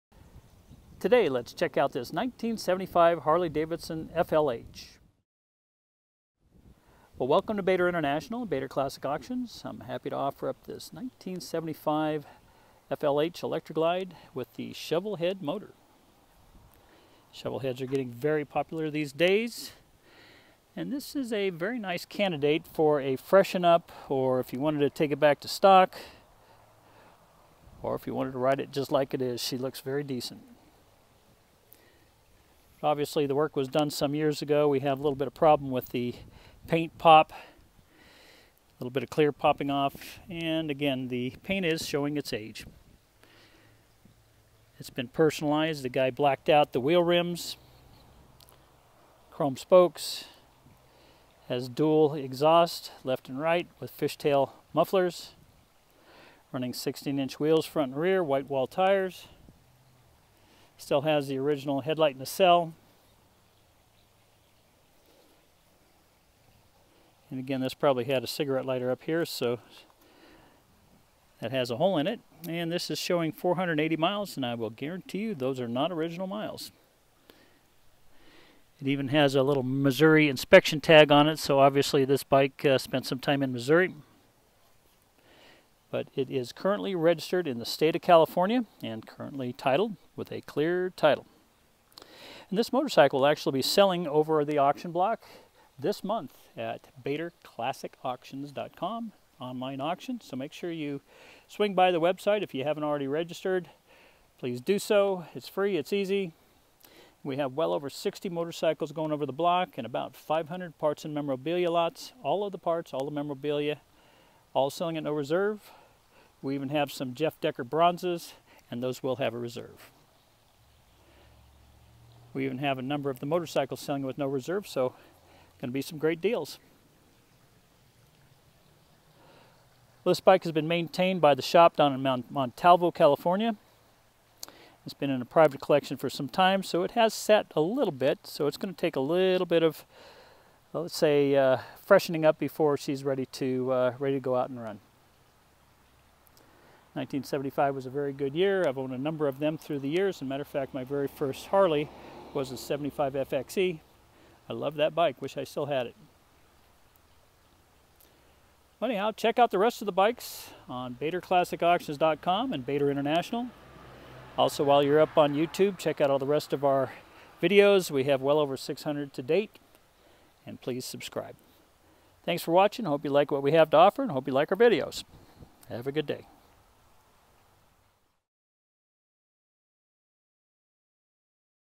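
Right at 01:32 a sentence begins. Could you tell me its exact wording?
And this motorcycle will actually be selling over the auction block this month at BatorClassicAuctions.com online auction.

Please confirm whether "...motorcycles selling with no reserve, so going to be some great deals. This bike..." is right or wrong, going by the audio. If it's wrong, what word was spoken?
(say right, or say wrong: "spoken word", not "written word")
right.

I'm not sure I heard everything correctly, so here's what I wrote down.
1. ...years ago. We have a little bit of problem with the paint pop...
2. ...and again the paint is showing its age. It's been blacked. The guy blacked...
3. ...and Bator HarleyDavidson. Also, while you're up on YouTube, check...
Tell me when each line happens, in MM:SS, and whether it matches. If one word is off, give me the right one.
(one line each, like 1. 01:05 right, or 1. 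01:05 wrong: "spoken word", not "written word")
1. 00:34 right
2. 00:40 wrong: "personalized", not "blacked"
3. 02:42 wrong: "International", not "HarleyDavidson".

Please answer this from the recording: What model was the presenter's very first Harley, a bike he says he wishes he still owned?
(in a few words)
75 FXE.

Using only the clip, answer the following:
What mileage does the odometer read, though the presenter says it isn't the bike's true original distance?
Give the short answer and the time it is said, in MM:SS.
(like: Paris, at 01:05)
480 miles, at 01:13.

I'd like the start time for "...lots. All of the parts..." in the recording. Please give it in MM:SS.
01:51.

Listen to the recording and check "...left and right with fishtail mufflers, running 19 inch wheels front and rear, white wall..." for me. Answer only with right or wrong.
wrong.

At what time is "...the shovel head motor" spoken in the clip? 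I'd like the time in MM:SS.
00:14.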